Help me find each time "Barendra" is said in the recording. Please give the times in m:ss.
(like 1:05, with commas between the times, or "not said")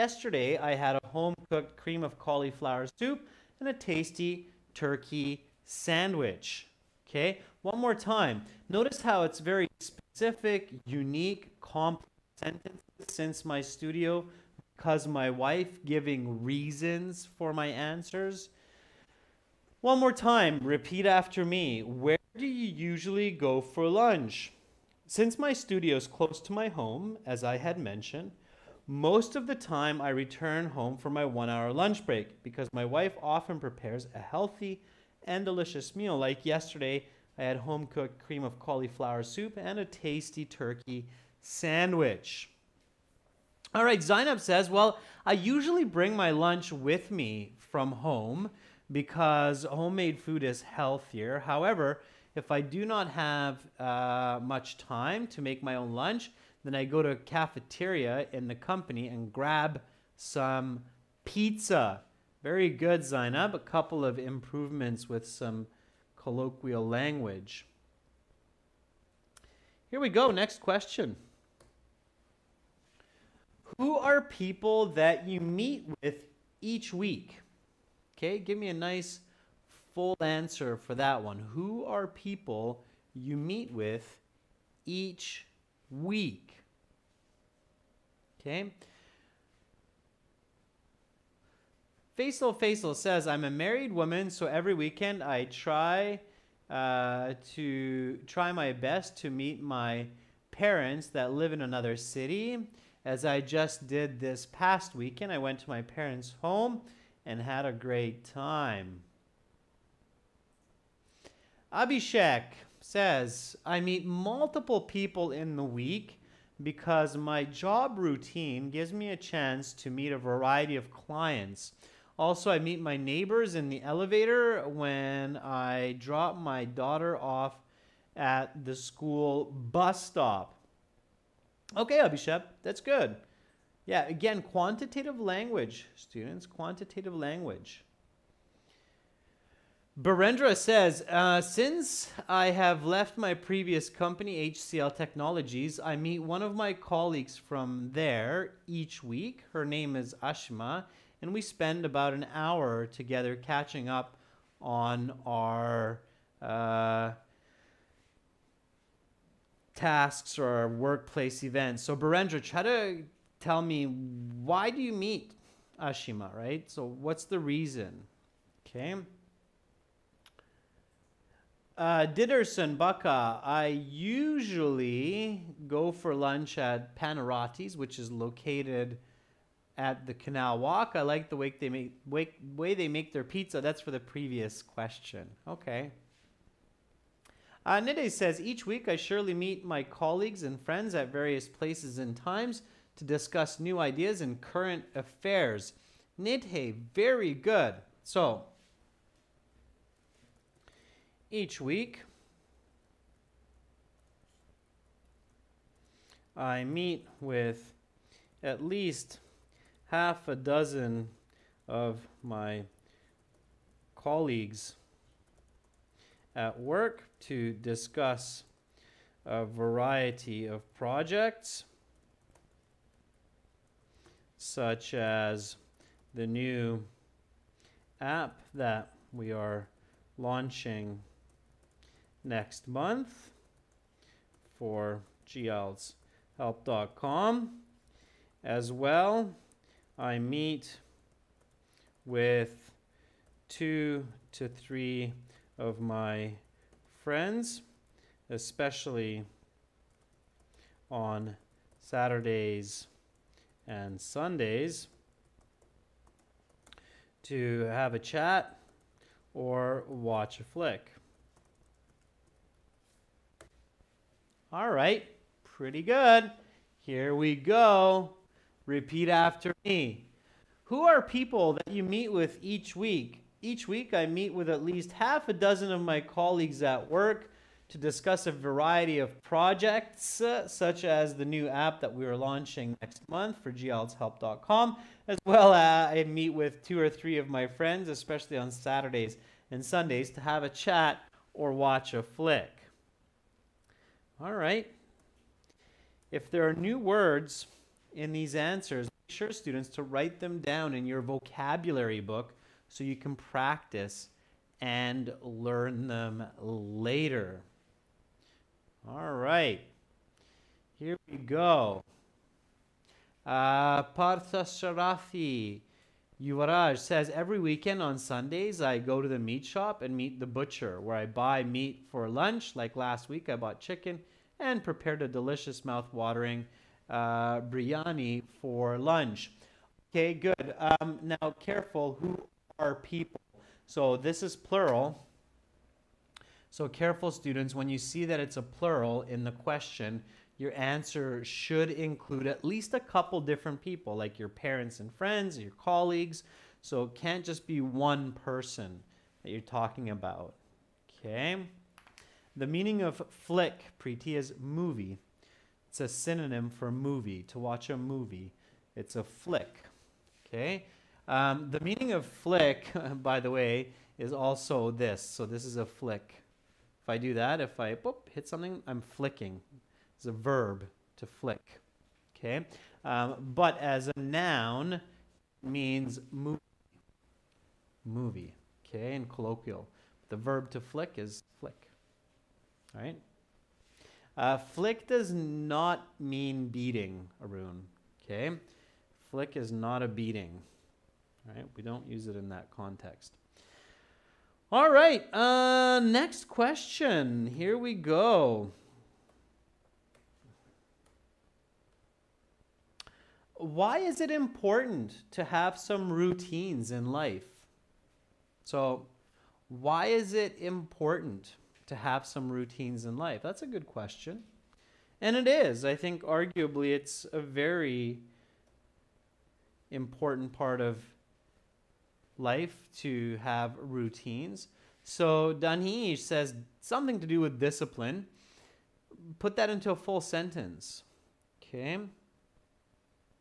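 2:19, 2:41.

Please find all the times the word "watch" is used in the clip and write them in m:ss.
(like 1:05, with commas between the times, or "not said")
4:19, 4:51, 5:57.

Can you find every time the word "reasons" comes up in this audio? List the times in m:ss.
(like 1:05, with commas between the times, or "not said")
0:16, 2:47.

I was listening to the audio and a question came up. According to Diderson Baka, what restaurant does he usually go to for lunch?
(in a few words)
Panarottis.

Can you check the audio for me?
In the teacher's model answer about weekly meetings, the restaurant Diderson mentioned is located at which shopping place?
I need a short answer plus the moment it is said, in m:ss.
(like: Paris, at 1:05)
Canal Walk, at 3:00.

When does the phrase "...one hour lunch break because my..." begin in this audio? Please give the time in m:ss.
0:31.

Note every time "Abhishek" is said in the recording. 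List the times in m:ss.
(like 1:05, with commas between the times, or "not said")
1:51, 2:11.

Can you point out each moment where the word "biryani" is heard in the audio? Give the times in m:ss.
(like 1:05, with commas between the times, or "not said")
5:27.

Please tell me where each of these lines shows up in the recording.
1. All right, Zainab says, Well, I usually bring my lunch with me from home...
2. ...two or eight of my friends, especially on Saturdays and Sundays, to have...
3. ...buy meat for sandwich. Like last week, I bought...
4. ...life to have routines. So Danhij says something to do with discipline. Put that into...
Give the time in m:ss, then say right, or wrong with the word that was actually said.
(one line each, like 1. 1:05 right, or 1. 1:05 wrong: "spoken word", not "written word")
1. 0:43 right
2. 4:46 wrong: "three", not "eight"
3. 5:21 wrong: "lunch", not "sandwich"
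4. 7:02 right.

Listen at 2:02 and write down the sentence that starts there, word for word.
Also, I meet my neighbors in the elevator when I drop my daughter off at the school bus stop.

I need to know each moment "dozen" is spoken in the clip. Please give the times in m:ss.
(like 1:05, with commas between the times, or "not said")
3:30, 4:35.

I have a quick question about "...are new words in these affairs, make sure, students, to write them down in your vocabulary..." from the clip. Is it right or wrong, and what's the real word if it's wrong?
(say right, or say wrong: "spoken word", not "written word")
wrong: "answers", not "affairs".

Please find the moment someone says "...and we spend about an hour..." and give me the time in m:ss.
2:31.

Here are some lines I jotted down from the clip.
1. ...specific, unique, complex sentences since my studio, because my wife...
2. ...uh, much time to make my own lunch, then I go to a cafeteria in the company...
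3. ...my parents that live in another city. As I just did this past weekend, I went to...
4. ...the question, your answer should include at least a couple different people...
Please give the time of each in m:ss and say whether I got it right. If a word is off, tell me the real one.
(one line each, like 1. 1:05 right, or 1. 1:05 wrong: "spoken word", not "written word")
1. 0:09 right
2. 0:53 right
3. 1:39 right
4. 5:39 right.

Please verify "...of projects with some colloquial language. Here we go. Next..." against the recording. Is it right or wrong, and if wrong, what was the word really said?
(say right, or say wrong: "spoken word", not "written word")
wrong: "improvements", not "projects".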